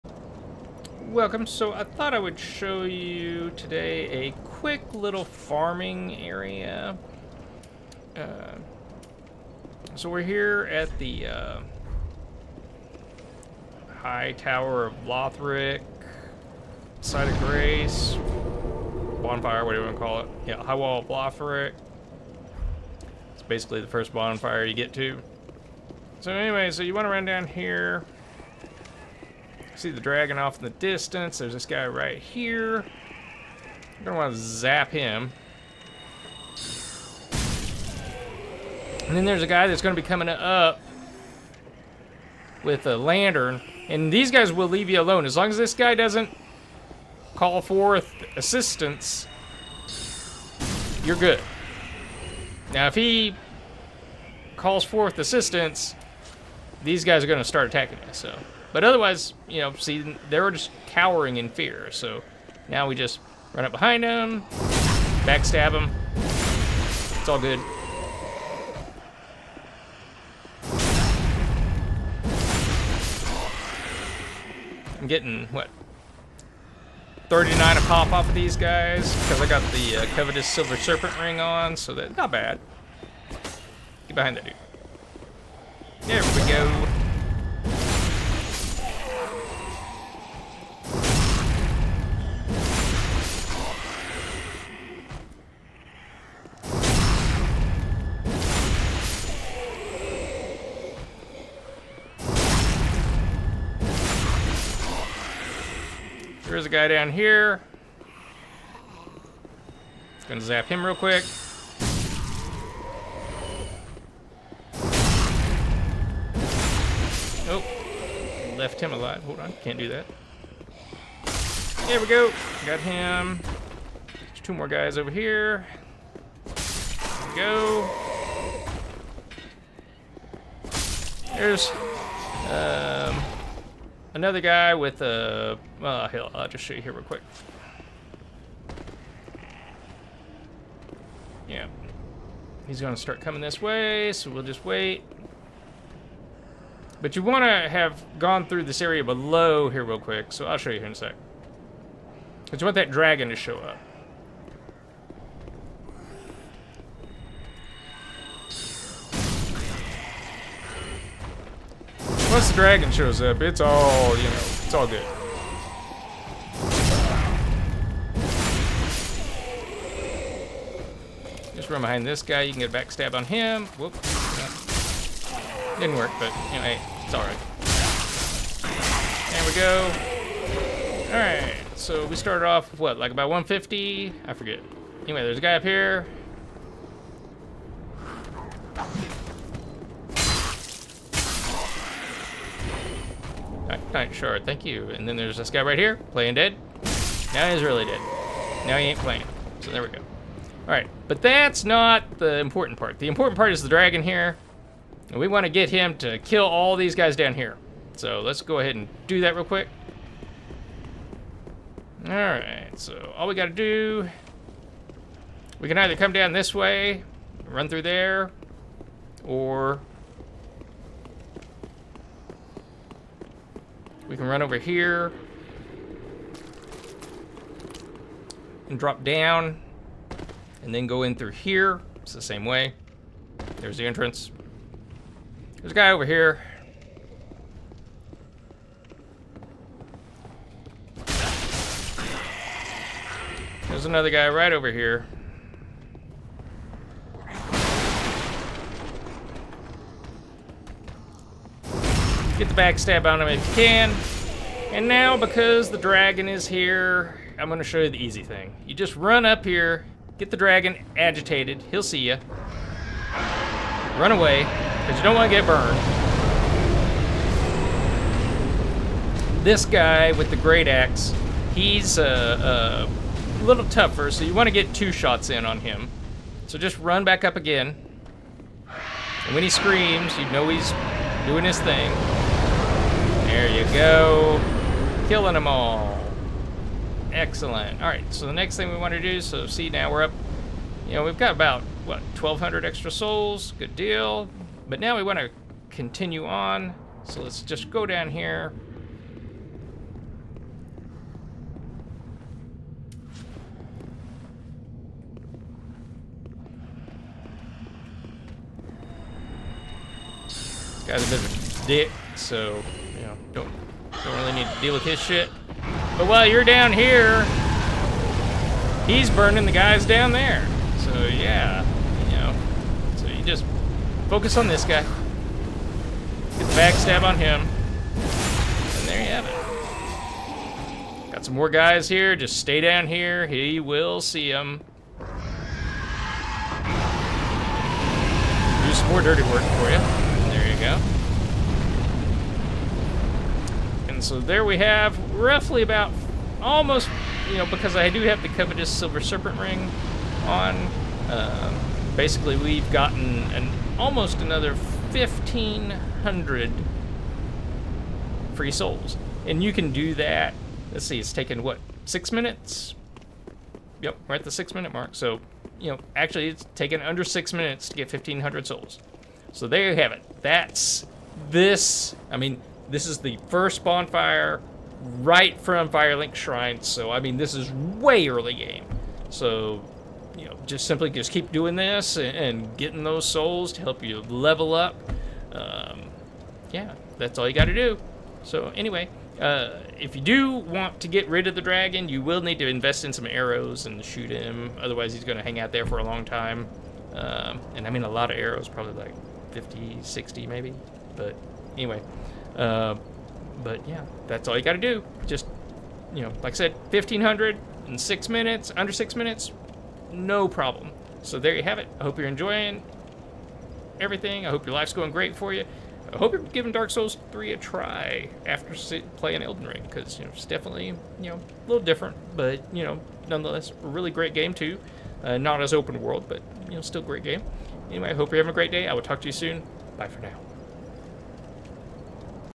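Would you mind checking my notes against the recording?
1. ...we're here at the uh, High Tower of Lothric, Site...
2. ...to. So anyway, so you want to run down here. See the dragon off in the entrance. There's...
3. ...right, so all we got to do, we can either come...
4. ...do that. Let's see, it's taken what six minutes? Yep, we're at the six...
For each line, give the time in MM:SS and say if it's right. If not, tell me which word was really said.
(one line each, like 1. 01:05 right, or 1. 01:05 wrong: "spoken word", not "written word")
1. 00:10 right
2. 00:24 wrong: "distance", not "entrance"
3. 03:32 right
4. 05:59 right.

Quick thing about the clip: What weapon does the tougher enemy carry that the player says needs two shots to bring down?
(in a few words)
Great axe.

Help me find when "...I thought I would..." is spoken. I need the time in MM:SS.
00:01.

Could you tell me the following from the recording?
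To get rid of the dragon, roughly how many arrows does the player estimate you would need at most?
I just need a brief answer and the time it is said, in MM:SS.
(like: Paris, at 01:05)
60, at 06:39.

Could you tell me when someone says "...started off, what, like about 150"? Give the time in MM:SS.
03:02.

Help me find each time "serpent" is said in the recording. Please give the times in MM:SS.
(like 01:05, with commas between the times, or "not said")
01:20, 05:48.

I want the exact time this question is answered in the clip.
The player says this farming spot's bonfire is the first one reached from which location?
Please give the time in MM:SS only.
06:15.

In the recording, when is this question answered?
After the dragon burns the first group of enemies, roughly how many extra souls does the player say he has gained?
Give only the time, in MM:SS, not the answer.
04:52.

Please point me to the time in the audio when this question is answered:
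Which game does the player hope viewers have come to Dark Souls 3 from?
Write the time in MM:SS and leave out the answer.
06:59.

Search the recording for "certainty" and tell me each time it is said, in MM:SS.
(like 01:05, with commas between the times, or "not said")
not said.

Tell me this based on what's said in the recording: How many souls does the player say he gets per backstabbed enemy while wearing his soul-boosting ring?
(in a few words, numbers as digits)
39.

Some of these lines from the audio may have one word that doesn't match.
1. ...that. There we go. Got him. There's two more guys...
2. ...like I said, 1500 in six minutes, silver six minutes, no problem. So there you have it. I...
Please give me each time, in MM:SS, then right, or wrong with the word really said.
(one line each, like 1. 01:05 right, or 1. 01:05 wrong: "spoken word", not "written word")
1. 01:59 right
2. 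06:46 wrong: "under", not "silver".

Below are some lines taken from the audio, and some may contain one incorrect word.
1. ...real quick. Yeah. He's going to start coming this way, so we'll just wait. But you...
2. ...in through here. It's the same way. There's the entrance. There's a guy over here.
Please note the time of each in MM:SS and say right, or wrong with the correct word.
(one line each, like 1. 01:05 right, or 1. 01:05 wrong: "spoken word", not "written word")
1. 02:16 right
2. 03:51 right.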